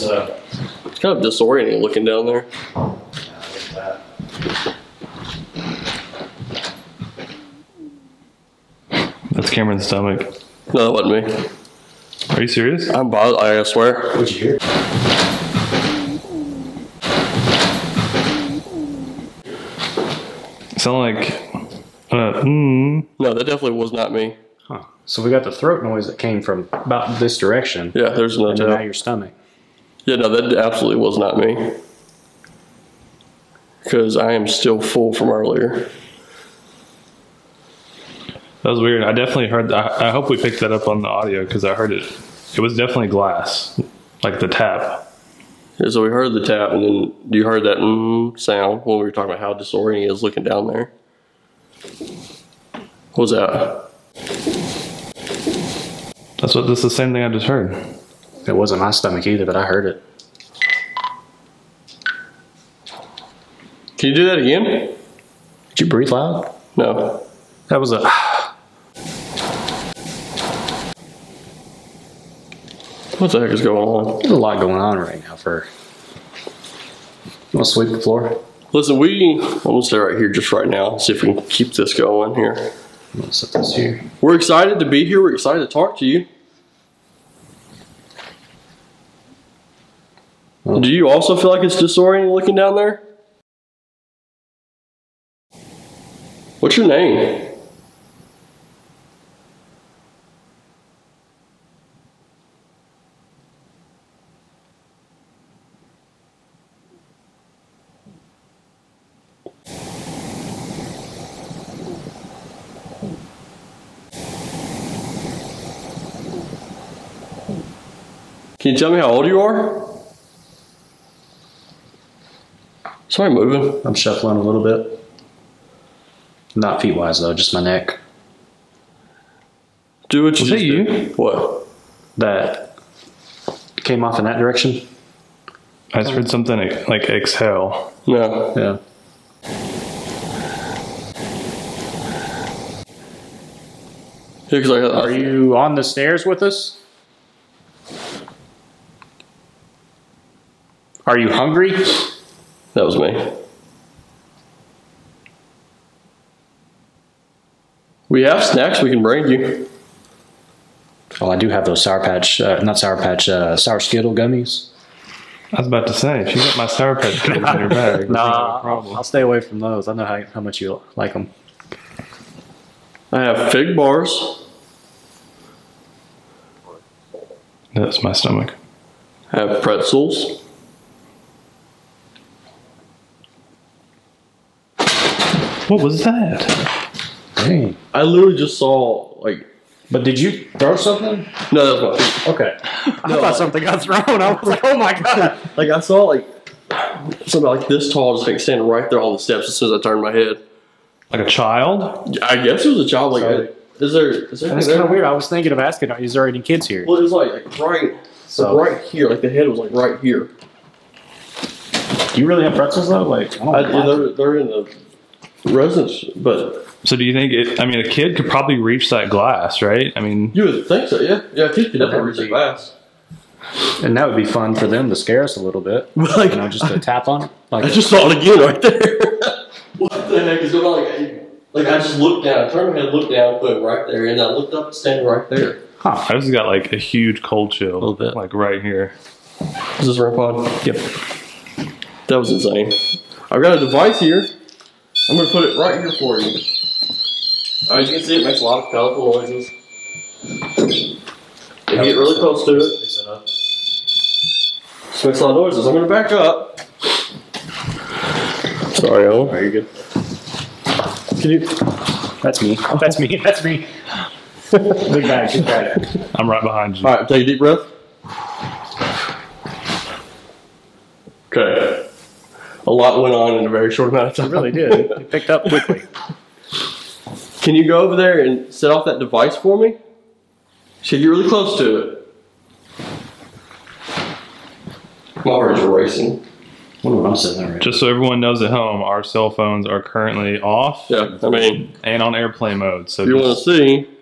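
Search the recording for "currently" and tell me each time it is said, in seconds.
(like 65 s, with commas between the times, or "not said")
289 s.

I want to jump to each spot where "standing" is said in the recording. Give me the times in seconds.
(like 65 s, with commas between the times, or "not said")
198 s, 234 s.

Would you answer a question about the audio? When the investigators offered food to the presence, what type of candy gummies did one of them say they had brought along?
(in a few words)
Sour Skittle gummies.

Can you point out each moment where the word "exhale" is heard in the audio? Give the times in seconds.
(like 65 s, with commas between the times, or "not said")
137 s.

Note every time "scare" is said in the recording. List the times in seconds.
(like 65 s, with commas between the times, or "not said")
224 s.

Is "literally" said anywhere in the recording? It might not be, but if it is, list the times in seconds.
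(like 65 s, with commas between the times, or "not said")
188 s.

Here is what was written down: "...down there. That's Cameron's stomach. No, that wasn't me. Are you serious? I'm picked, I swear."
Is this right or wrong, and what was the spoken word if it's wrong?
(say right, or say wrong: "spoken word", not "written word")
wrong: "bothered", not "picked".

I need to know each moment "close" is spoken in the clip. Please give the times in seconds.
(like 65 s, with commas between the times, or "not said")
252 s, 281 s.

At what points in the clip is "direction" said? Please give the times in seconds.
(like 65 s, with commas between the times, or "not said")
27 s, 134 s.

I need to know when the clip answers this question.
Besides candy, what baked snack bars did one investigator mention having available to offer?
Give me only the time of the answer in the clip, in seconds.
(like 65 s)
173 s.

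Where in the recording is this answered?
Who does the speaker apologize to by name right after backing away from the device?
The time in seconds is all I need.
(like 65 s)
259 s.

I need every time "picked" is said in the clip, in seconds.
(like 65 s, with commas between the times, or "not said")
40 s, 275 s.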